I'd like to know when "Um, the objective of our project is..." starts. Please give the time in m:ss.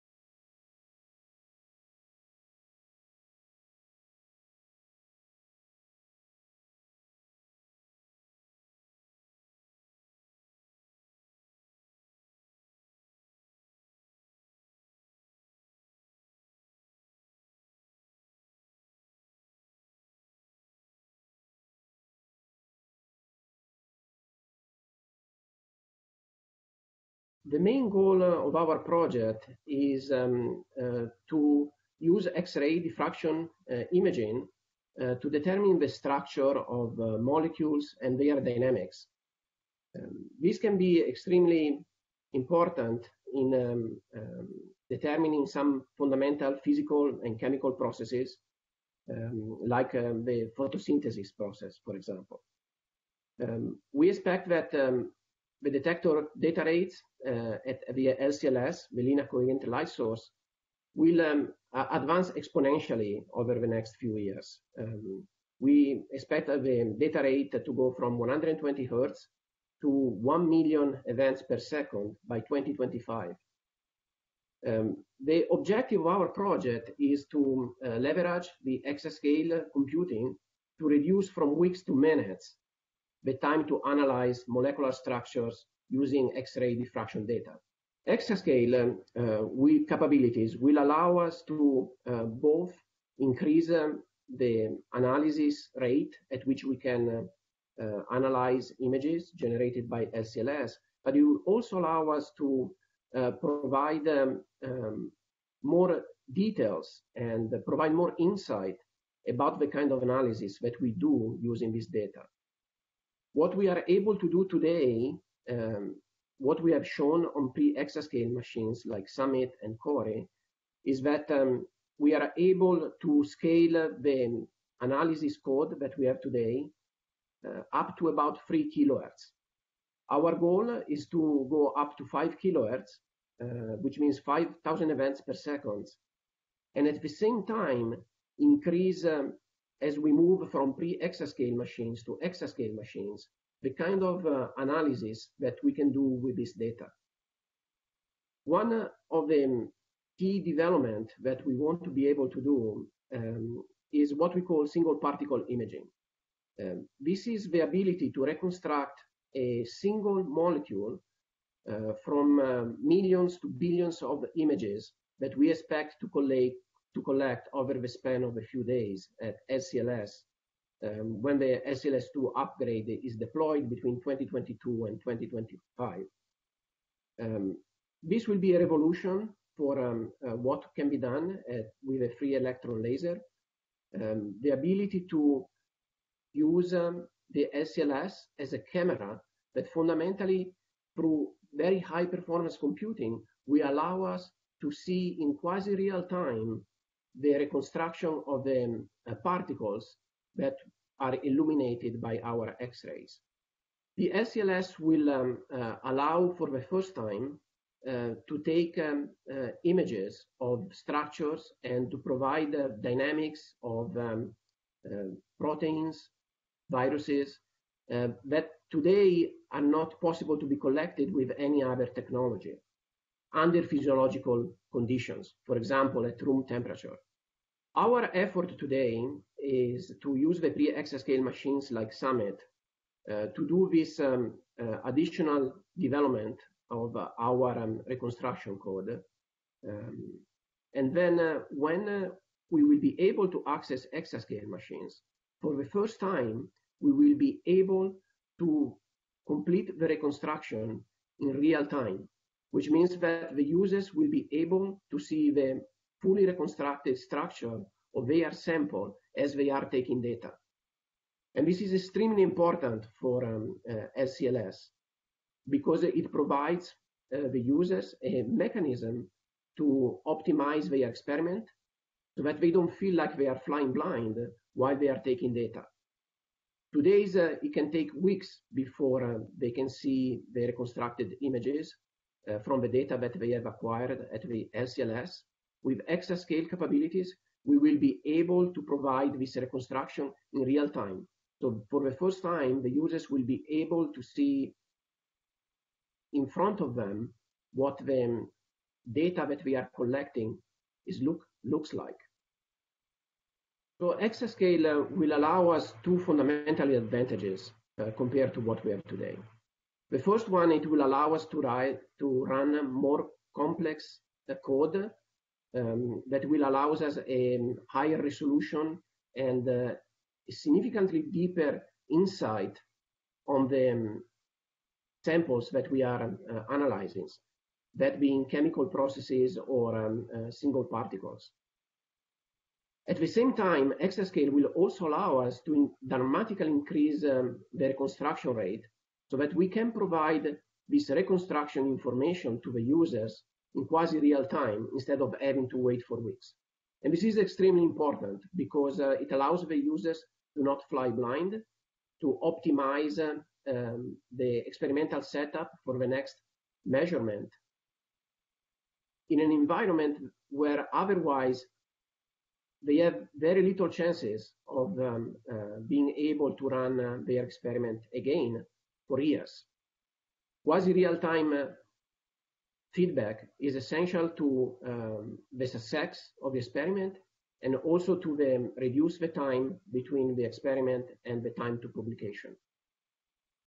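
1:14.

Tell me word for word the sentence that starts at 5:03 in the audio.
So exascale uh, will allow us two fundamental advantages uh, compared to what we have today.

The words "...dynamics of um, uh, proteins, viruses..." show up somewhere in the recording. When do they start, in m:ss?
3:32.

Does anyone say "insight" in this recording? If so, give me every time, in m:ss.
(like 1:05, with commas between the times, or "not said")
1:48, 5:21.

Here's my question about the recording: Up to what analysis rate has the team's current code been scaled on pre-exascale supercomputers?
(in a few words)
3 kilohertz.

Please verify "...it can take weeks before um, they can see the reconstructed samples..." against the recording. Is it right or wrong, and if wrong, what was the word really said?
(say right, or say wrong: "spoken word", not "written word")
wrong: "images", not "samples".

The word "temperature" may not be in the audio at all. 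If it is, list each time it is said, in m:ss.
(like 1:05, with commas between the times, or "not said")
3:46.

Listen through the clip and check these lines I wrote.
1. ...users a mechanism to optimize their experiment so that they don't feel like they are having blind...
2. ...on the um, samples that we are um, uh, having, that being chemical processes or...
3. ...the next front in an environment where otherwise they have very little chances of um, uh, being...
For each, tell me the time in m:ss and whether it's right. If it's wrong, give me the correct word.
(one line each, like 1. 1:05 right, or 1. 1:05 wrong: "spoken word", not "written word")
1. 4:27 wrong: "flying", not "having"
2. 5:23 wrong: "analyzing", not "having"
3. 5:55 wrong: "measurement", not "front".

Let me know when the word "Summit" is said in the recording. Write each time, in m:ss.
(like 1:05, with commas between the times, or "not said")
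1:59, 3:51.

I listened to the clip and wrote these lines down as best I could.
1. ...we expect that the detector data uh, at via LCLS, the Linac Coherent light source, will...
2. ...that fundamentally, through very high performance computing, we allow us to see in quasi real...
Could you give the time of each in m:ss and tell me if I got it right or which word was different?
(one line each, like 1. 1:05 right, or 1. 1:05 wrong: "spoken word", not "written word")
1. 0:53 right
2. 3:09 right.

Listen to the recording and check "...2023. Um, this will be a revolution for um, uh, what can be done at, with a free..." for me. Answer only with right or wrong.
wrong.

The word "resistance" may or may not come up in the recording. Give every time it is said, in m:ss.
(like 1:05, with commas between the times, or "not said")
not said.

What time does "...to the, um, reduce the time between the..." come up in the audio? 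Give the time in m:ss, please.
6:17.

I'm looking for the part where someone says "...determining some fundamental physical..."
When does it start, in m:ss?
0:44.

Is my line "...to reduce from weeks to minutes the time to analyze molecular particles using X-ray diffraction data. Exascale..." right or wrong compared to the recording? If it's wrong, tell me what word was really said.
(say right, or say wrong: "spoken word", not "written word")
wrong: "structures", not "particles".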